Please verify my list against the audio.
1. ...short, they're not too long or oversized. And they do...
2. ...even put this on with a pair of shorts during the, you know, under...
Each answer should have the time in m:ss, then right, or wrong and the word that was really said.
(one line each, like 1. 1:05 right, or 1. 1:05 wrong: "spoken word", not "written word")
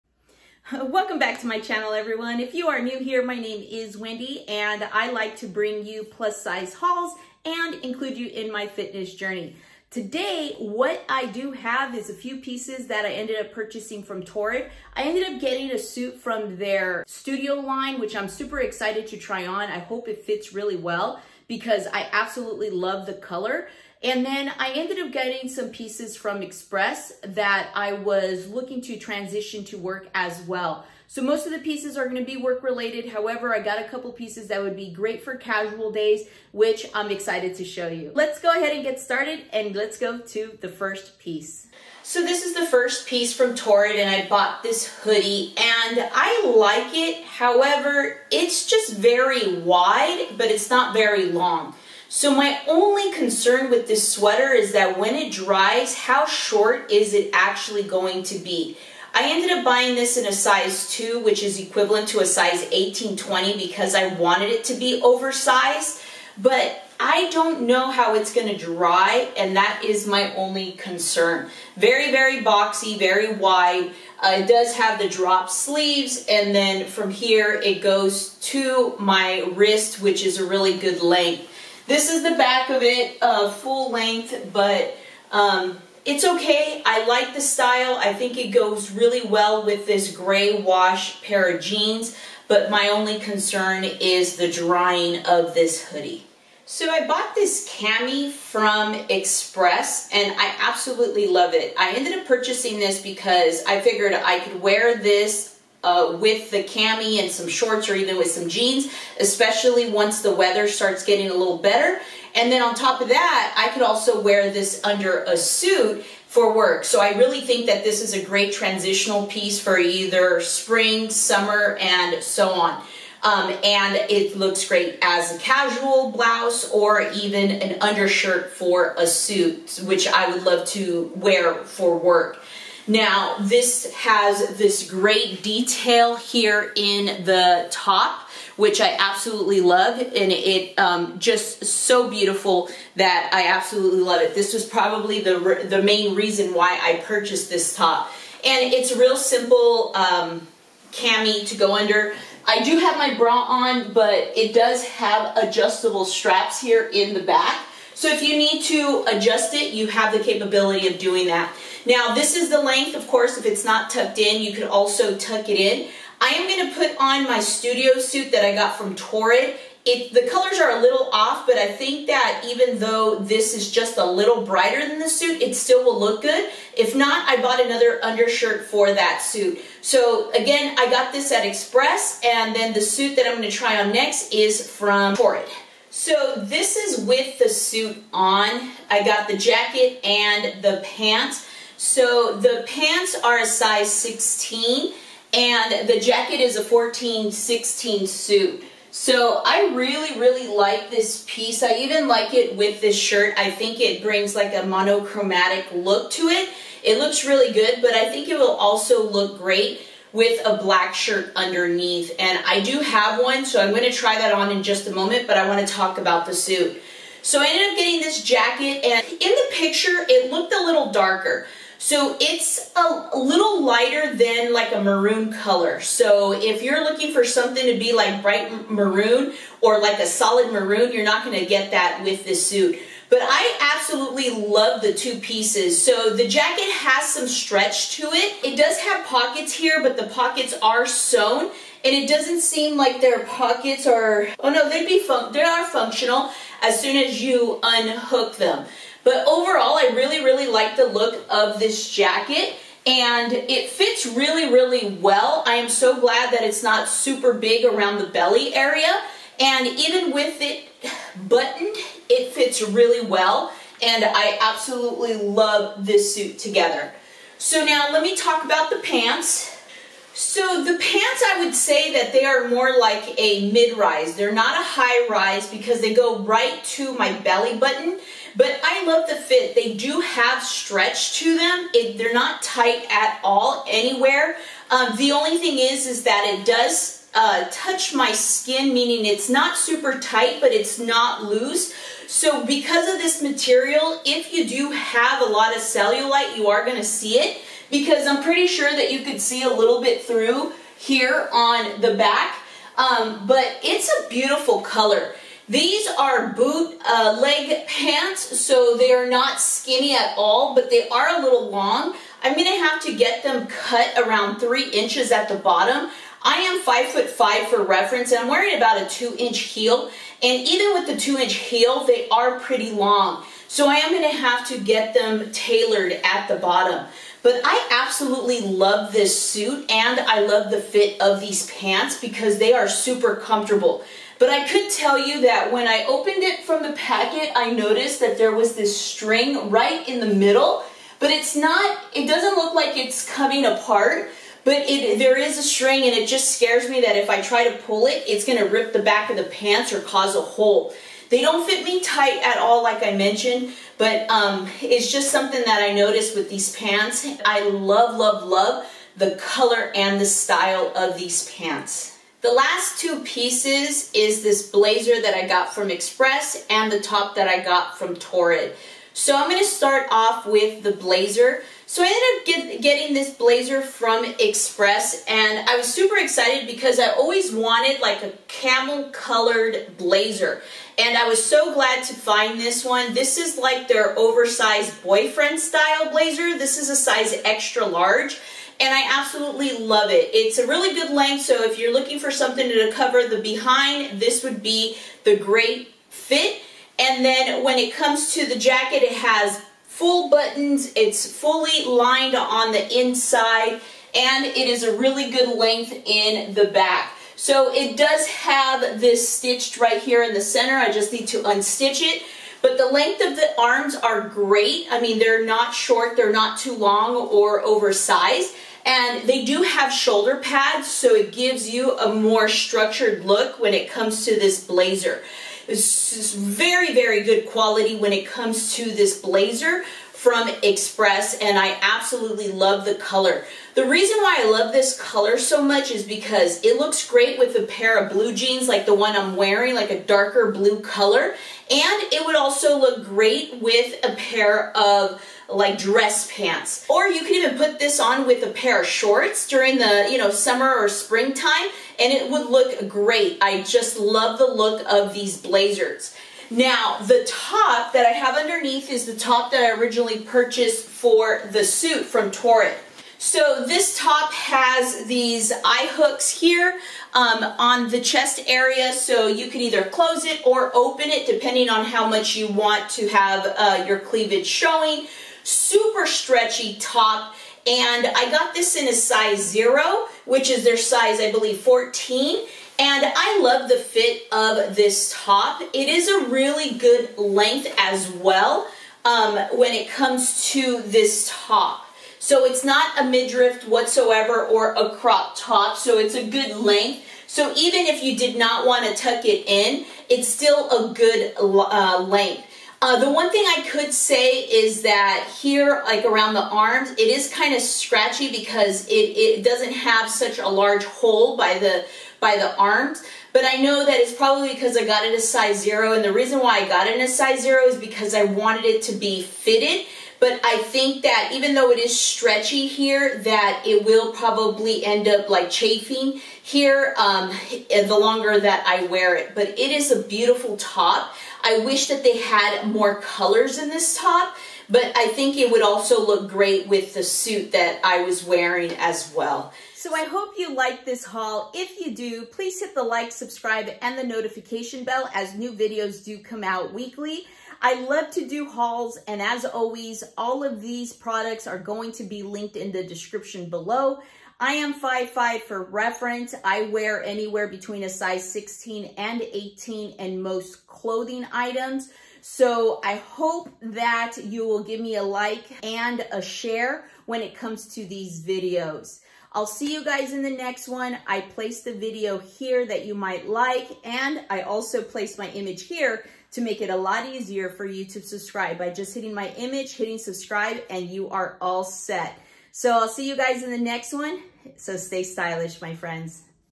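1. 6:55 right
2. 7:27 wrong: "summer", not "under".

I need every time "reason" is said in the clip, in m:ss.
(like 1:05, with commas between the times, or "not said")
2:26, 7:13, 8:35.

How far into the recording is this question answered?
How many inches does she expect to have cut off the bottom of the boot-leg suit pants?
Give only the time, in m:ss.
5:14.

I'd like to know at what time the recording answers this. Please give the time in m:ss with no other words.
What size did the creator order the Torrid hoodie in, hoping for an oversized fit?
1:00.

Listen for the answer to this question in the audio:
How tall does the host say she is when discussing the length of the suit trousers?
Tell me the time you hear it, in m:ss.
5:16.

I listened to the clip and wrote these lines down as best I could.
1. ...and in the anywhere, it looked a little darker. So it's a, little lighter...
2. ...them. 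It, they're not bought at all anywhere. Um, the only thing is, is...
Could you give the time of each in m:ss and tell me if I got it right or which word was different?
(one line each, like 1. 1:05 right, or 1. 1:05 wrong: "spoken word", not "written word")
1. 3:38 wrong: "picture", not "anywhere"
2. 4:41 wrong: "tight", not "bought".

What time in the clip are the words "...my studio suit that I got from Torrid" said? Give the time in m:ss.
2:47.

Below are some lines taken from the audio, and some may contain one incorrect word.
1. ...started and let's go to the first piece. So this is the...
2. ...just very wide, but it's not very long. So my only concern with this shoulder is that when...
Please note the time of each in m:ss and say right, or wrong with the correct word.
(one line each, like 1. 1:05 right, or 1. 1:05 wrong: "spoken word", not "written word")
1. 0:38 right
2. 0:48 wrong: "sweater", not "shoulder".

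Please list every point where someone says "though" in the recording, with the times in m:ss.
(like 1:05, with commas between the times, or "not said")
2:52, 8:41.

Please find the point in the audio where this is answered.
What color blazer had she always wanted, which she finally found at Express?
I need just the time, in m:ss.
6:18.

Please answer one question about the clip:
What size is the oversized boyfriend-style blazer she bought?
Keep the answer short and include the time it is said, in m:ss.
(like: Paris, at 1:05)
Extra large, at 6:27.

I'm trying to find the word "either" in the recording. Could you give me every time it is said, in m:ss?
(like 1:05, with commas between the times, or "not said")
1:59, 7:49.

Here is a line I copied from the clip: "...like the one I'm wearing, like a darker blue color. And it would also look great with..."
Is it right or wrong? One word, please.
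right.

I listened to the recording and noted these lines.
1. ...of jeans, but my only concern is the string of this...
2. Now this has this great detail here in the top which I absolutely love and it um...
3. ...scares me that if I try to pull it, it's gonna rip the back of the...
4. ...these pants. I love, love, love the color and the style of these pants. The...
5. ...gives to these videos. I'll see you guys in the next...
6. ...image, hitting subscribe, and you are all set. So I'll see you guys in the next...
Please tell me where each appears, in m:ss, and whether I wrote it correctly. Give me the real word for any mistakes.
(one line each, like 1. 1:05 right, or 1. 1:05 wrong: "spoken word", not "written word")
1. 1:31 wrong: "drying", not "string"
2. 2:12 right
3. 5:46 right
4. 5:56 right
5. 9:27 wrong: "comes", not "gives"
6. 9:39 right.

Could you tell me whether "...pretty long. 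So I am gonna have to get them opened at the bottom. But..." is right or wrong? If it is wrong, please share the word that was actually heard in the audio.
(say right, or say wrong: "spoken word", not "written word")
wrong: "tailored", not "opened".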